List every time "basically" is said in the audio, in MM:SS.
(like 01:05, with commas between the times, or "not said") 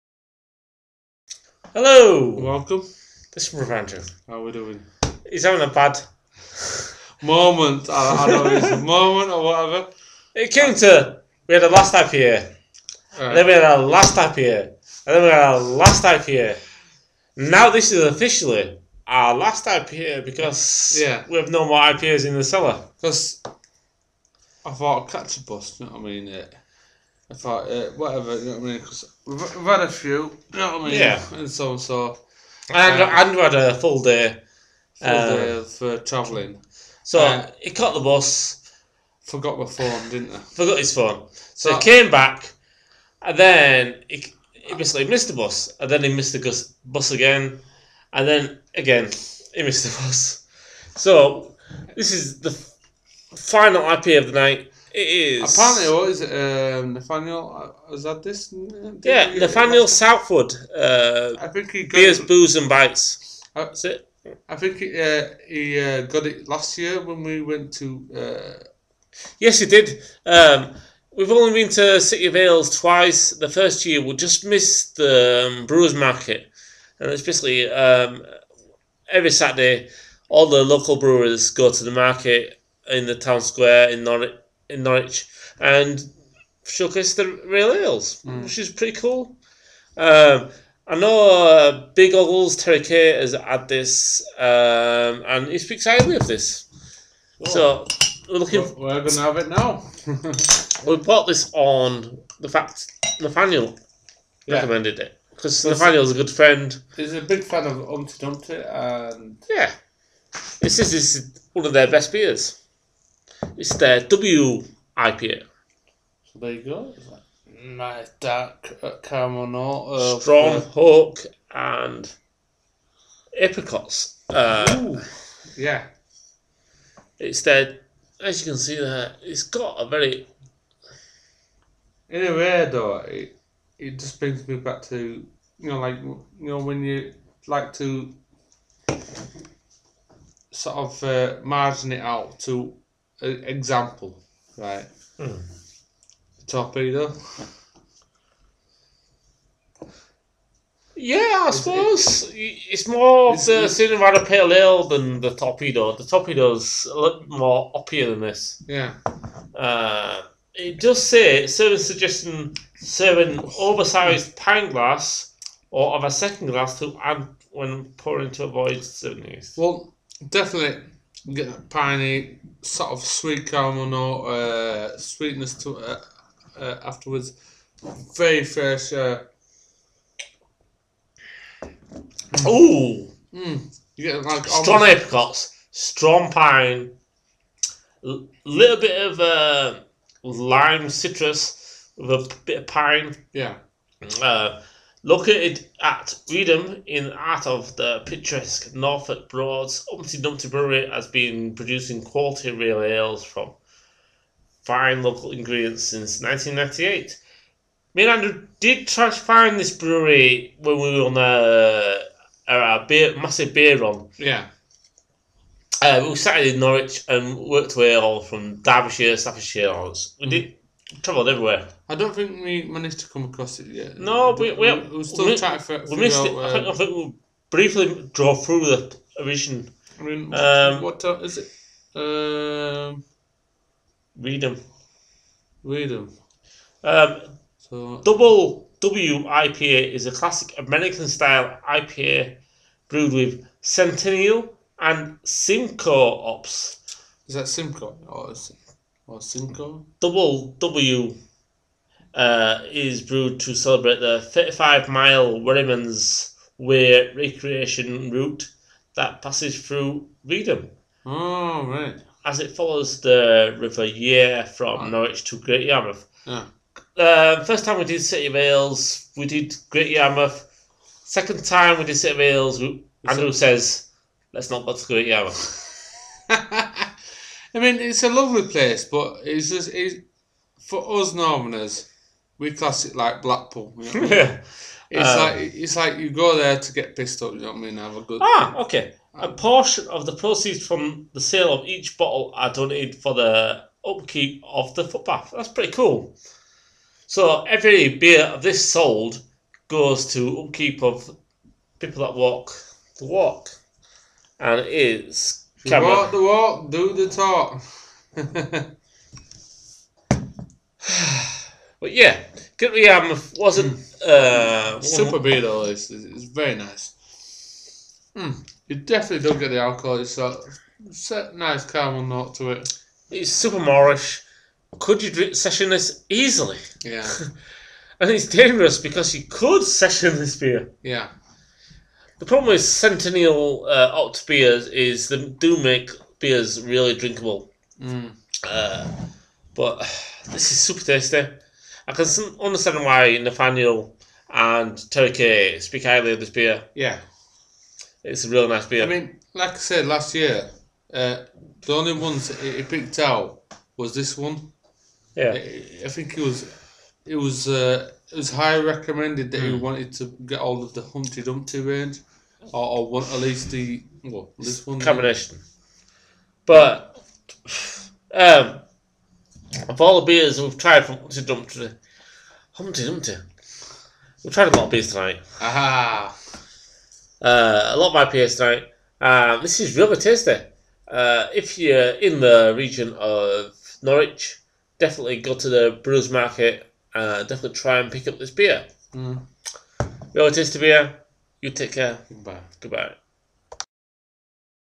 00:44, 01:17.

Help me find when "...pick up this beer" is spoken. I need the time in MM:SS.
06:27.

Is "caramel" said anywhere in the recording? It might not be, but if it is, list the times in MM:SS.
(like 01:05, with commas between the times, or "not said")
01:59, 02:53, 05:21.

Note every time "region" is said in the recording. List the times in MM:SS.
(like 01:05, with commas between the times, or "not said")
06:22.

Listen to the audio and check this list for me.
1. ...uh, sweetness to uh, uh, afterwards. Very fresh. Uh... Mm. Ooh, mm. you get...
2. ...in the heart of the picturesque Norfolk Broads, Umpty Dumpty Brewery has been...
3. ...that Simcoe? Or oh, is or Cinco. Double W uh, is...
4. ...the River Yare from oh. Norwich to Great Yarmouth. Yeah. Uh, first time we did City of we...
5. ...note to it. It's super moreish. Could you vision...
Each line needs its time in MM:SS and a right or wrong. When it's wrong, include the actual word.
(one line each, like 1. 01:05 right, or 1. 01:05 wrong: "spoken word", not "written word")
1. 02:54 right
2. 03:16 right
3. 04:07 right
4. 04:23 right
5. 05:22 wrong: "session", not "vision".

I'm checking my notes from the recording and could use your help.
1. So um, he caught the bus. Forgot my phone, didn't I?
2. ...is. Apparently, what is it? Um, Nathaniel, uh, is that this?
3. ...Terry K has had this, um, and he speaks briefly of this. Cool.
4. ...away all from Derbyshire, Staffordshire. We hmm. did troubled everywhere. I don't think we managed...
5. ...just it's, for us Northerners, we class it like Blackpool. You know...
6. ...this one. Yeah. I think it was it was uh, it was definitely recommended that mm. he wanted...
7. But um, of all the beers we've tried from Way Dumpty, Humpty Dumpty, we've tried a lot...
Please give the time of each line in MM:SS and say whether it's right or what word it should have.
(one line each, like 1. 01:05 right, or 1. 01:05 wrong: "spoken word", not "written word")
1. 00:37 right
2. 00:55 right
3. 01:32 wrong: "highly", not "briefly"
4. 03:37 right
5. 04:39 right
6. 05:53 wrong: "highly", not "definitely"
7. 06:06 wrong: "Humpty", not "Way".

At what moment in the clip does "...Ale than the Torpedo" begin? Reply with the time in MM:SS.
02:34.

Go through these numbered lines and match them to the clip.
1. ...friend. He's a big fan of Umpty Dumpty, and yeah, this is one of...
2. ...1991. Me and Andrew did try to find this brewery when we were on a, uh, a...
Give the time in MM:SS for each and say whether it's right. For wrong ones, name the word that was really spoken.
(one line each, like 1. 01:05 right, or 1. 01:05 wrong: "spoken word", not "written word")
1. 01:46 right
2. 03:26 wrong: "1998", not "1991".